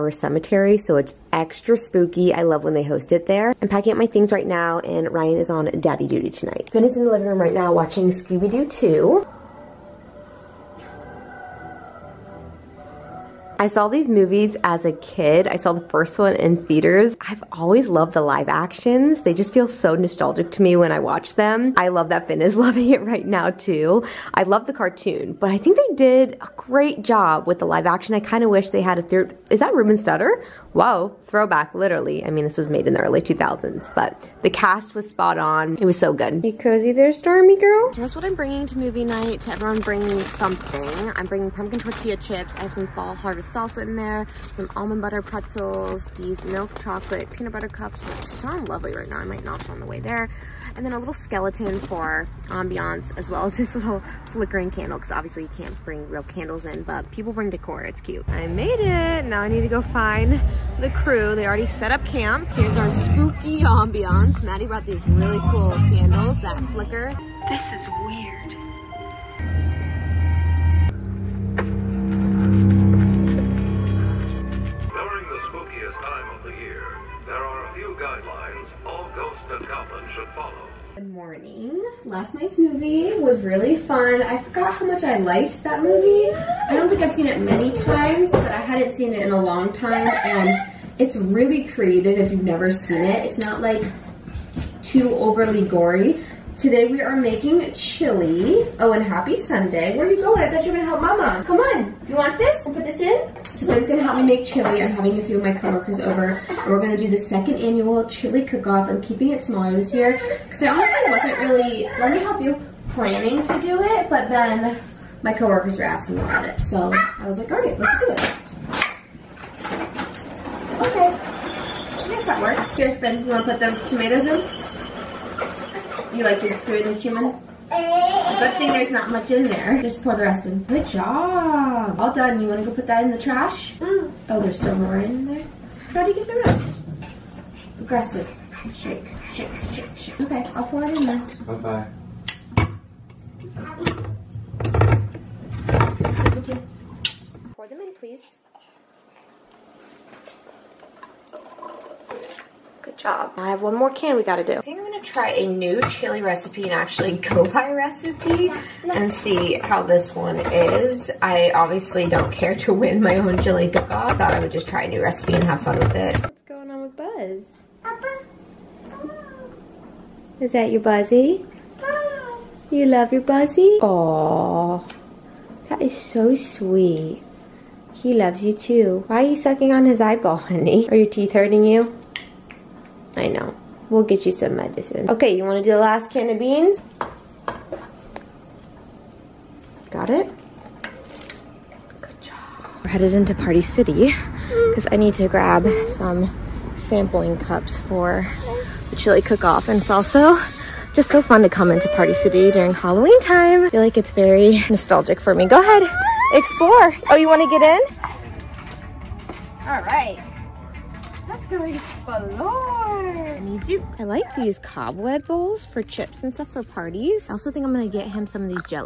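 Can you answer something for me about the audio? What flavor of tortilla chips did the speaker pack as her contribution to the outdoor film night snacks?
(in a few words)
Pumpkin.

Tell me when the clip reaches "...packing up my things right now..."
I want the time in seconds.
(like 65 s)
3 s.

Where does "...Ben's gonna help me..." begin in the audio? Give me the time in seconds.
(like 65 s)
103 s.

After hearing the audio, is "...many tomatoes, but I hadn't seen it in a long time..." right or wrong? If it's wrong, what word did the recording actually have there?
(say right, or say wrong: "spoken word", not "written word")
wrong: "times", not "tomatoes".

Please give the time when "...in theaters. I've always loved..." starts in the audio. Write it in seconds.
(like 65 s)
16 s.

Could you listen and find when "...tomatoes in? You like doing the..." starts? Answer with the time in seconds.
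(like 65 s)
123 s.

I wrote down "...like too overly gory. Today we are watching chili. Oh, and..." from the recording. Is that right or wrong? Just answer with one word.
wrong.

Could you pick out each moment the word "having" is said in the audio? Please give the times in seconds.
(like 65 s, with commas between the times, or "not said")
104 s.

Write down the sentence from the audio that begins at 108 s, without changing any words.
I'm keeping it smaller this year because I honestly wasn't really.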